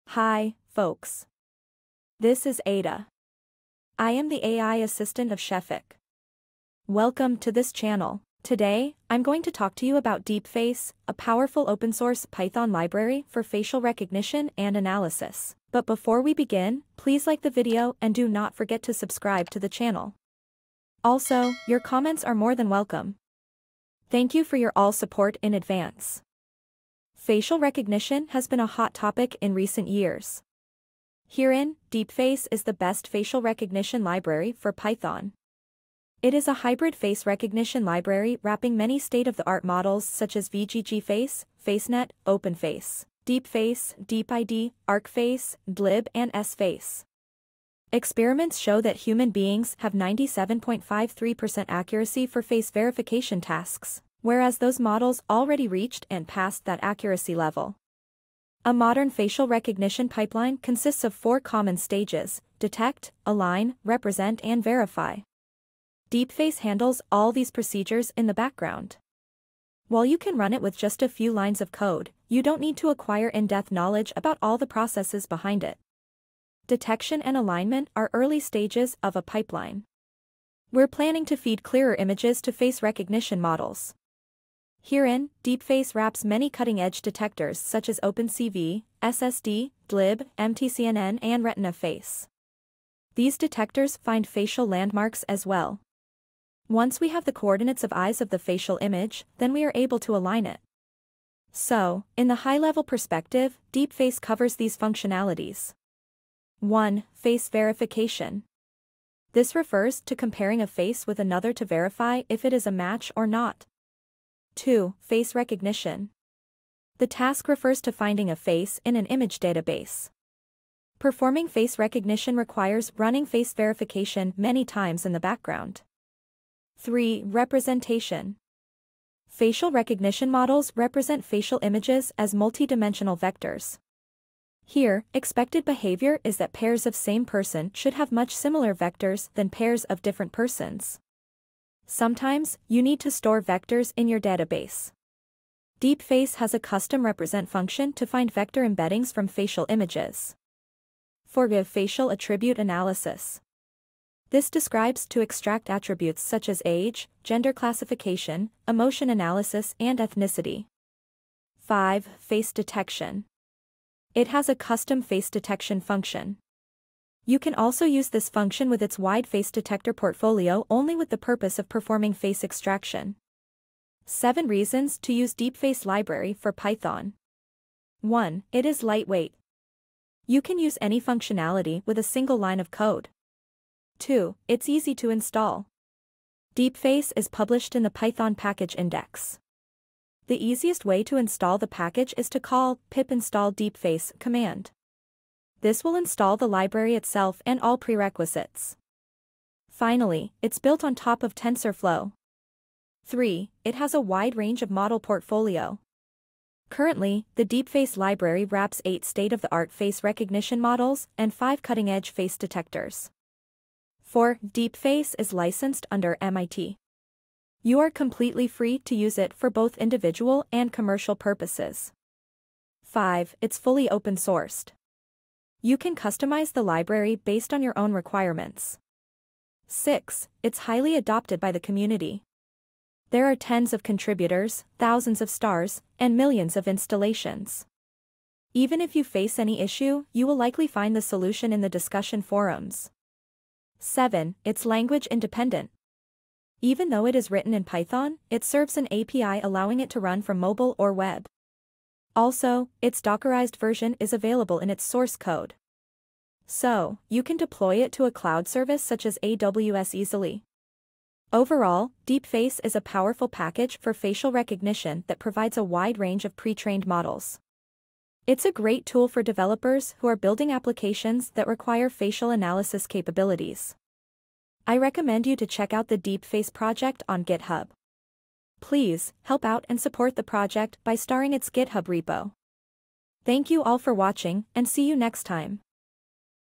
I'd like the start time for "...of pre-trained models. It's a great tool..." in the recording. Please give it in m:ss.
4:26.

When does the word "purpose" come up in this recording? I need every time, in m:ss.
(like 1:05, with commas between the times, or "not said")
2:51, 3:41.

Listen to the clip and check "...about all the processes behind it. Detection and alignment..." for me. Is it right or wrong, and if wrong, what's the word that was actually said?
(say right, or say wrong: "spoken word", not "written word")
right.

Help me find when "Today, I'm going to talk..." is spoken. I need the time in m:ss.
0:08.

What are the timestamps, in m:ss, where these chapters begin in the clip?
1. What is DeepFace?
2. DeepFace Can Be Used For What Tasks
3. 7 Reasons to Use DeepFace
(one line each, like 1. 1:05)
1. 0:26
2. 1:41
3. 2:54.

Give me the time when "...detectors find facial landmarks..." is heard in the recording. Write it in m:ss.
1:33.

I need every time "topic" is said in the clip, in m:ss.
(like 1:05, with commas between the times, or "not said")
0:28.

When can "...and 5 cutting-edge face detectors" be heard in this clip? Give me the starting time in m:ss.
3:31.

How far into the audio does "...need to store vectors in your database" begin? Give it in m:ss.
2:22.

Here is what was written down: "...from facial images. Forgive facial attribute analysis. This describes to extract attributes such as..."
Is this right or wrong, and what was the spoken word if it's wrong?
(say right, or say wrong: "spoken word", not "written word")
right.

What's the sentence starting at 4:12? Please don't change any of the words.
Also, its Dockerized version is available in its source code.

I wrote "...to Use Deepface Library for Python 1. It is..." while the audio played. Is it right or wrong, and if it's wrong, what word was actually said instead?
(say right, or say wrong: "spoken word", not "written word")
right.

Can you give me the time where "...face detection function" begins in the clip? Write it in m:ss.
2:45.